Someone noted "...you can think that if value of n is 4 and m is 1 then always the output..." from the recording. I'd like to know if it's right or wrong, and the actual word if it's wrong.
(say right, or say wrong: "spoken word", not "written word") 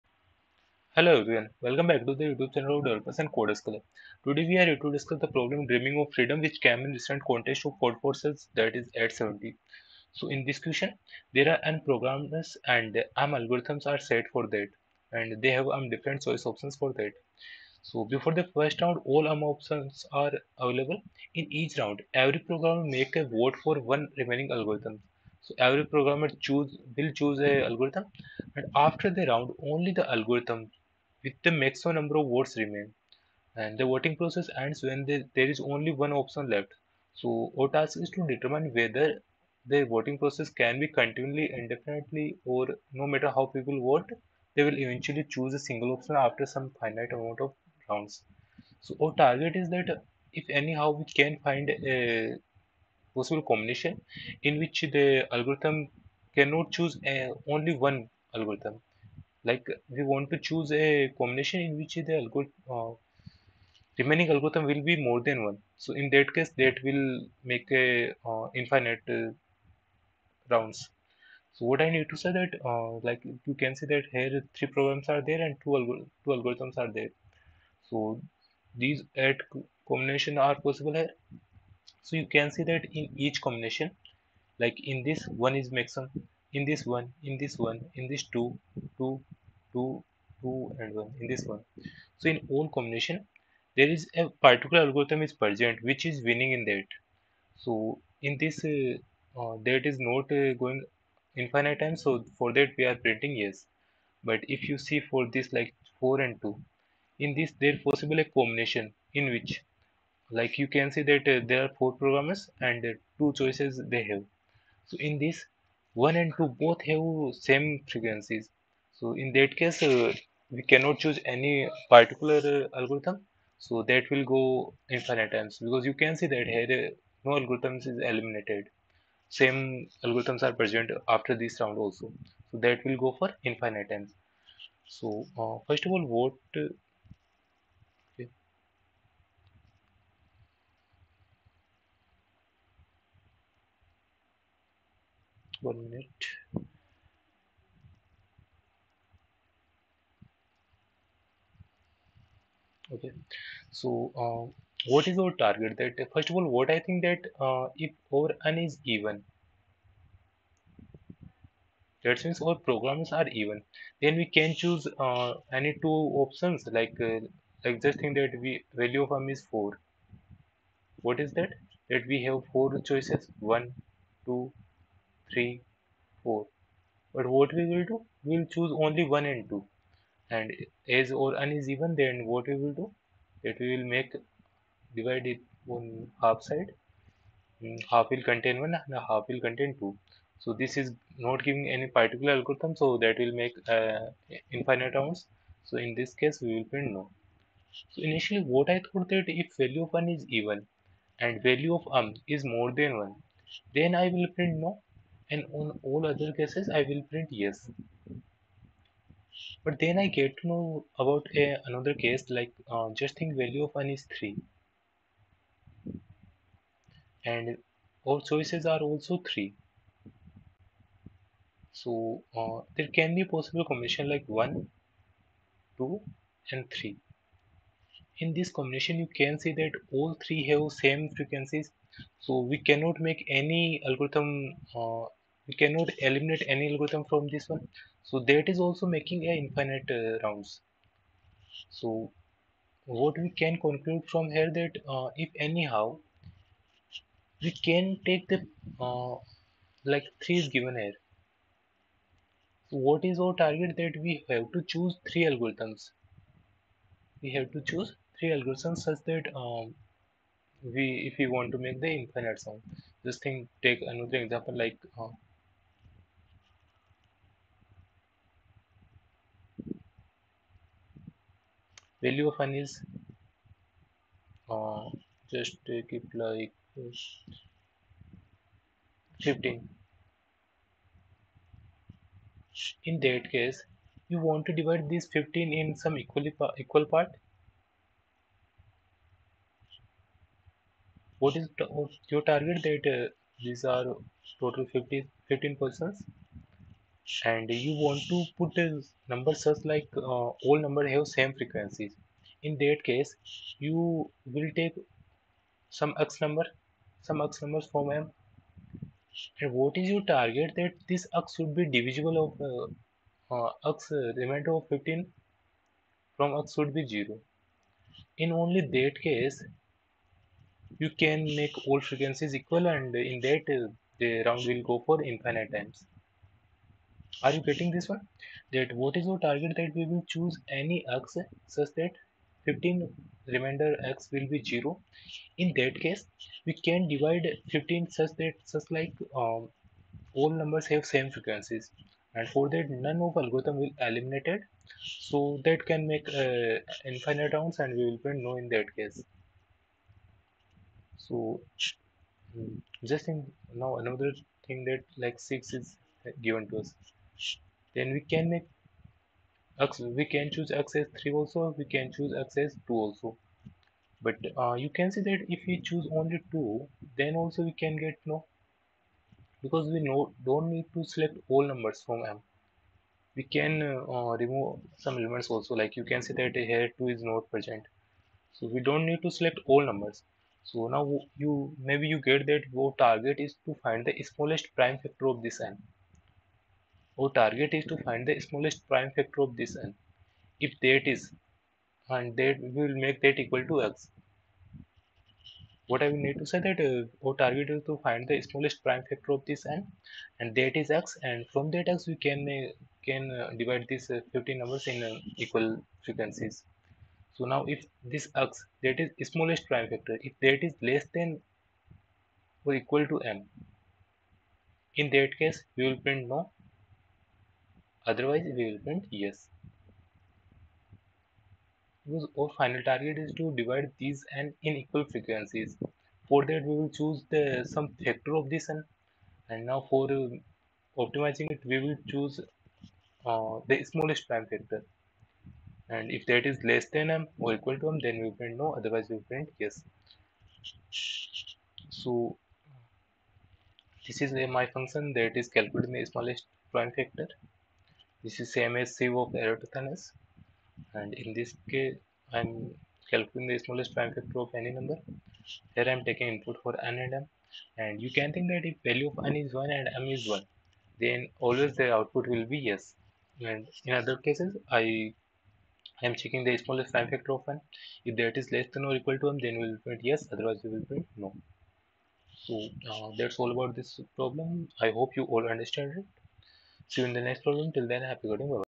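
wrong: "1", not "4".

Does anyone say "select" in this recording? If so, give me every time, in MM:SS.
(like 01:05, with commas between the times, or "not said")
06:10, 06:19.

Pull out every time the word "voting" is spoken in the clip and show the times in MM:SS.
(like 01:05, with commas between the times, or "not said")
00:33, 00:39.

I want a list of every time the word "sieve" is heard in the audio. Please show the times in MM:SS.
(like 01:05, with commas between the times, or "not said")
07:28.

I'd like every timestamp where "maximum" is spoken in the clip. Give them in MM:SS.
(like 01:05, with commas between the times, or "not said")
00:31, 01:25.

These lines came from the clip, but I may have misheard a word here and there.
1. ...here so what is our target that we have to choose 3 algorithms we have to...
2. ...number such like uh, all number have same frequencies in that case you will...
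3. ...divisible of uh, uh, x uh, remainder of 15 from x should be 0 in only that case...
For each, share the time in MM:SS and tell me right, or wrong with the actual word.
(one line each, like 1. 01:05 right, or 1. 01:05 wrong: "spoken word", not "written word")
1. 04:10 right
2. 04:59 right
3. 05:11 right.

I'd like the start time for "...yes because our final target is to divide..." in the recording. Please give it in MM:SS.
06:58.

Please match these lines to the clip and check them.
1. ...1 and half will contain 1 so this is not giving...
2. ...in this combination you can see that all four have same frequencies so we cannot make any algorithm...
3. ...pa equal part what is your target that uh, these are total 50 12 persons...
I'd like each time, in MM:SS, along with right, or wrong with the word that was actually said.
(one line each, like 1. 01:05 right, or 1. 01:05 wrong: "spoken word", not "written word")
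1. 03:08 wrong: "2", not "1"
2. 03:48 wrong: "three", not "four"
3. 04:46 wrong: "15", not "12".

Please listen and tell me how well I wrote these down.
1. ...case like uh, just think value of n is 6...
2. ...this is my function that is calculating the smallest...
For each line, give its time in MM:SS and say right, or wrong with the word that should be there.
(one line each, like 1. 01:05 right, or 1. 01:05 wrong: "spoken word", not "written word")
1. 03:31 wrong: "3", not "6"
2. 07:23 right.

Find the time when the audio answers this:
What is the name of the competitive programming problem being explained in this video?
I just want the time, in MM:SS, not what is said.
00:05.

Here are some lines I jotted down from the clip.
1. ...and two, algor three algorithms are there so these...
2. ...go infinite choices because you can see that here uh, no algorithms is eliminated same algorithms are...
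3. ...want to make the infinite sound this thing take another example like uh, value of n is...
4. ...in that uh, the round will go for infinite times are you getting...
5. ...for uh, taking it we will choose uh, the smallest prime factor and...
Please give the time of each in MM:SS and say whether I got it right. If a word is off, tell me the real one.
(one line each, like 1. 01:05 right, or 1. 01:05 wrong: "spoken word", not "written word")
1. 01:15 wrong: "two", not "three"
2. 02:04 wrong: "times", not "choices"
3. 04:21 right
4. 05:23 right
5. 07:09 wrong: "optimizing", not "taking".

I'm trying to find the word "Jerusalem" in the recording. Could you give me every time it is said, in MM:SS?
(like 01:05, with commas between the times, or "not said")
not said.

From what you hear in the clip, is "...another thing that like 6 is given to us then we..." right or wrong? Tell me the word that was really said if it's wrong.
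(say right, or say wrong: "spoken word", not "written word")
right.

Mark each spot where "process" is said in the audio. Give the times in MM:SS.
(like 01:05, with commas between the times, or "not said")
00:34, 00:40.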